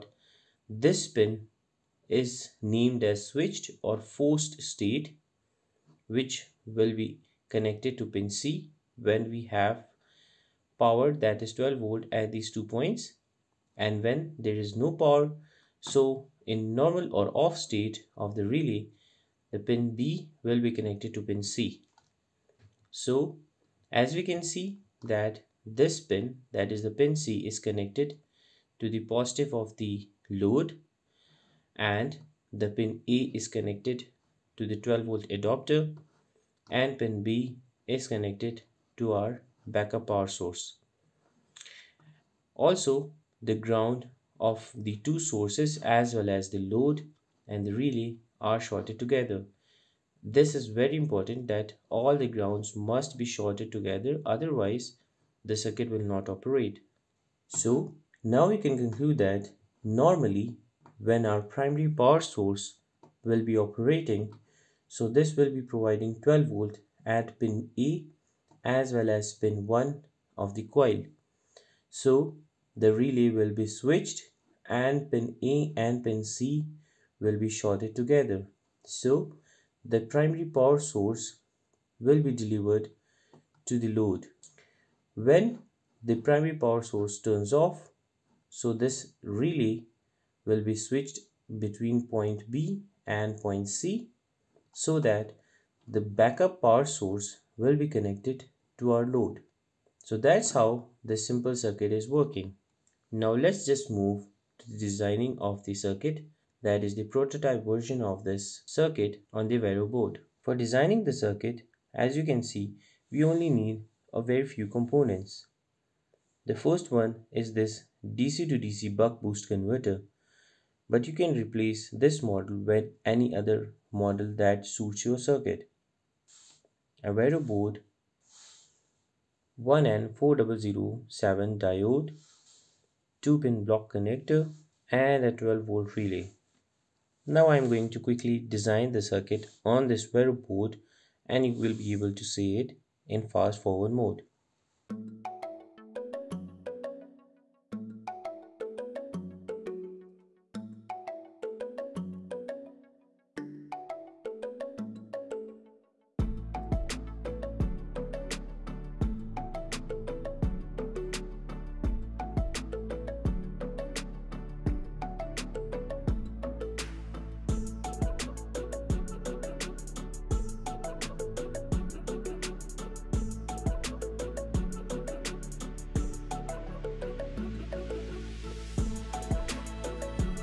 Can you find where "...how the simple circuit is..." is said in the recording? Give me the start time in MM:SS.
01:40.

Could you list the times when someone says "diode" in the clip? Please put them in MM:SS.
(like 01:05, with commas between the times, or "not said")
02:11.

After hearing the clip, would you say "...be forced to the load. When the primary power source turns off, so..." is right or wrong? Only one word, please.
wrong.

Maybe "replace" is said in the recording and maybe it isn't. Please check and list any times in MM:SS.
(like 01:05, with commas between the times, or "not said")
02:01.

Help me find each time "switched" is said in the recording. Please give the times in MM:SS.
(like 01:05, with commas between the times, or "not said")
00:03, 01:13, 01:30.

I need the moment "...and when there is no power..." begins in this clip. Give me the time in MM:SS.
00:13.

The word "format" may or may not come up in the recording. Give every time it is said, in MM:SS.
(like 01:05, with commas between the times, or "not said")
not said.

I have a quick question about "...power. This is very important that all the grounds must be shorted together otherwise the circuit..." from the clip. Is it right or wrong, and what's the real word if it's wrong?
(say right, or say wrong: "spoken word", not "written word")
wrong: "together", not "power".